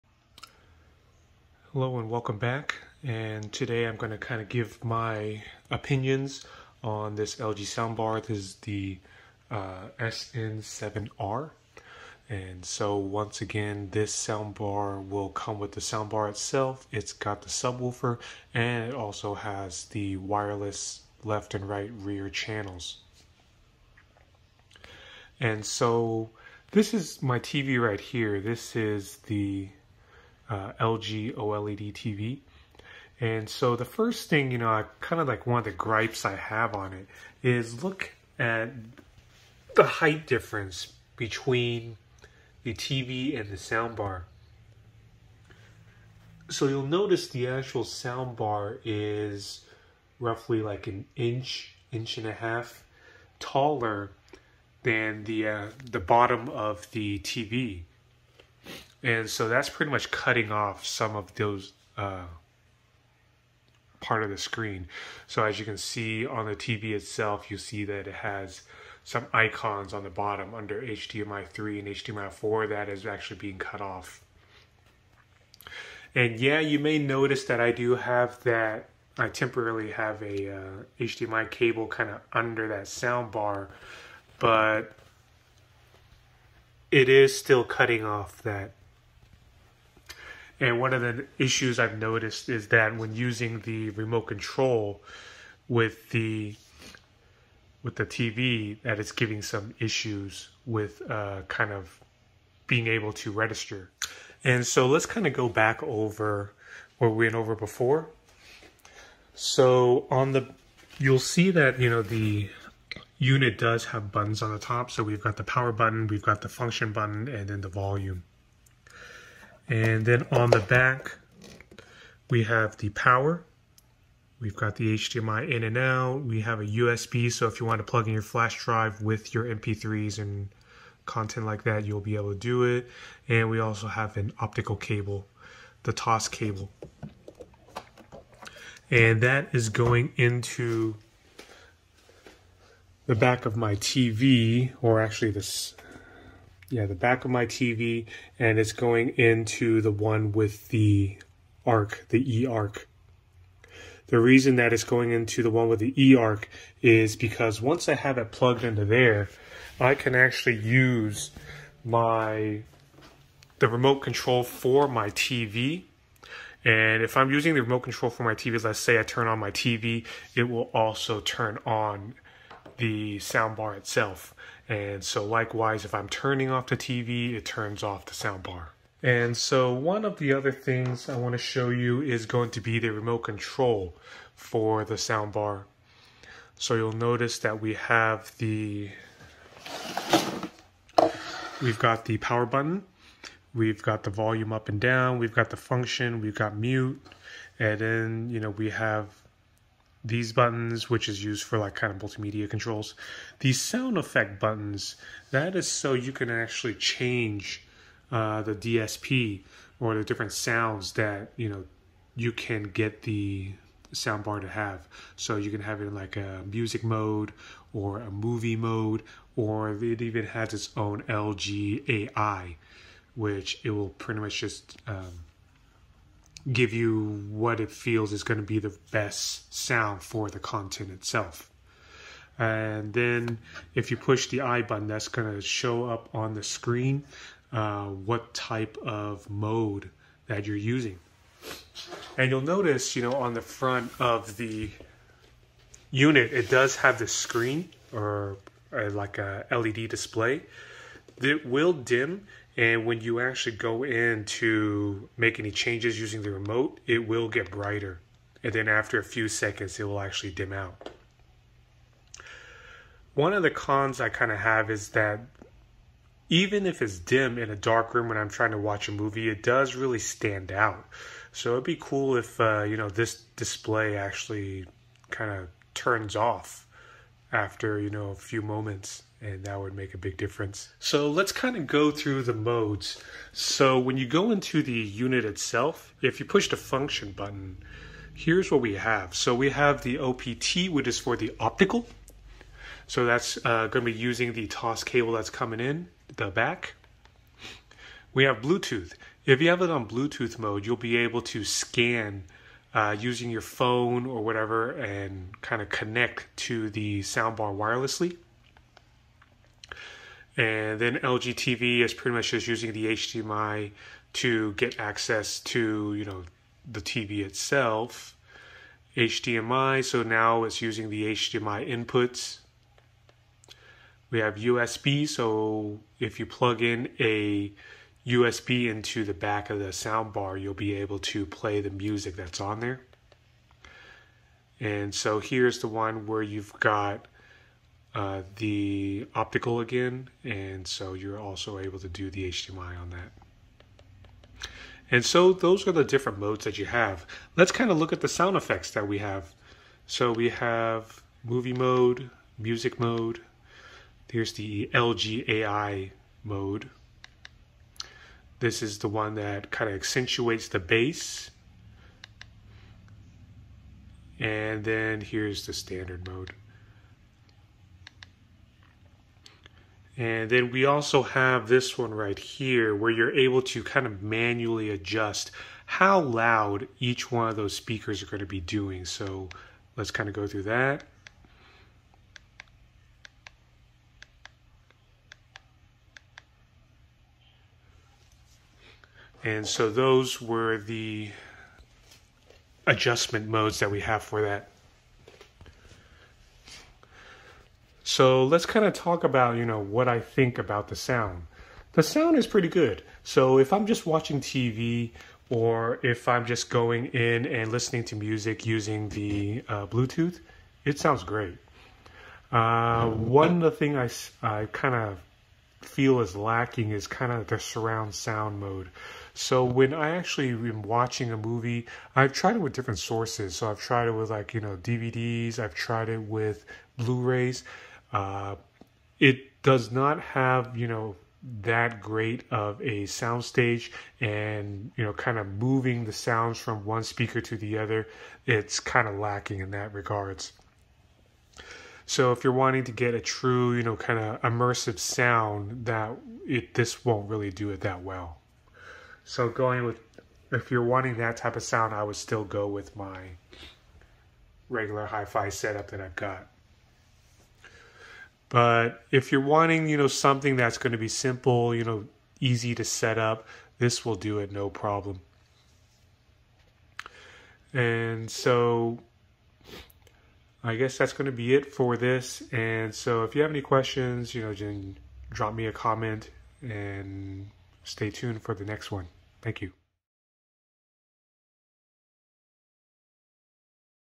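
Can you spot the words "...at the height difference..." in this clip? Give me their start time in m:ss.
0:38.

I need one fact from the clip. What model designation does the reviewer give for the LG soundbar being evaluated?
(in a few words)
SN7R.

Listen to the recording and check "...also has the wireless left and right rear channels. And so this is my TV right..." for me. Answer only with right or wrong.
right.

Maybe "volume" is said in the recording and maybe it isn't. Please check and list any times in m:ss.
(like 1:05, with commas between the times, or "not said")
1:57, 3:14.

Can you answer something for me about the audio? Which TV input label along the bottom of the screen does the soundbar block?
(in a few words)
HDMI 3 / HDMI 4.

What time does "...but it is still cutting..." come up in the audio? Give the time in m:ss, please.
1:24.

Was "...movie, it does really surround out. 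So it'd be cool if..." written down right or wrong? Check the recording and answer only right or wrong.
wrong.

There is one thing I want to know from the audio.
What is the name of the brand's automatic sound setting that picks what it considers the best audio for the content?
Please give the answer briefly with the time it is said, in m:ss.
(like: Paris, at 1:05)
LG AI, at 3:41.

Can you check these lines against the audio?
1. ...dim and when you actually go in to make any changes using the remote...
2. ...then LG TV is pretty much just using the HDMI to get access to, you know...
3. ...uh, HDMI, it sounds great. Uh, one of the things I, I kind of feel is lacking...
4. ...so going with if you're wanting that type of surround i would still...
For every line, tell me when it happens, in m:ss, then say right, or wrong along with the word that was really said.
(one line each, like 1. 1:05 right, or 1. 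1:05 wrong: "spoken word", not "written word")
1. 4:11 right
2. 5:10 right
3. 6:49 wrong: "Bluetooth", not "HDMI"
4. 7:29 wrong: "sound", not "surround".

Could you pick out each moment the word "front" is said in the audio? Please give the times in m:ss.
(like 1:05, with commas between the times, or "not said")
4:03.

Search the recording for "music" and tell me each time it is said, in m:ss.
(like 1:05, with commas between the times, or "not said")
3:36, 5:31, 5:52, 6:47.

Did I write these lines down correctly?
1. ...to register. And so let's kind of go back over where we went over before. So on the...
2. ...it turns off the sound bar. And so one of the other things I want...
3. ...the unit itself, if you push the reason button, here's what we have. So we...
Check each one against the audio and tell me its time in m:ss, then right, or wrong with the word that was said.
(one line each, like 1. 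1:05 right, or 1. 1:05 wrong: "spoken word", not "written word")
1. 1:43 right
2. 2:57 right
3. 4:44 wrong: "function", not "reason".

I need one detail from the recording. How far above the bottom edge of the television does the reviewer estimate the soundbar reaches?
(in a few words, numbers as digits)
an inch, inch and a half.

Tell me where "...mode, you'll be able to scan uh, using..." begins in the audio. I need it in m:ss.
5:00.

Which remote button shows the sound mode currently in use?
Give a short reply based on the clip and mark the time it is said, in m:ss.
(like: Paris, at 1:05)
I button, at 3:54.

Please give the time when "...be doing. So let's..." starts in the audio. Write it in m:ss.
6:18.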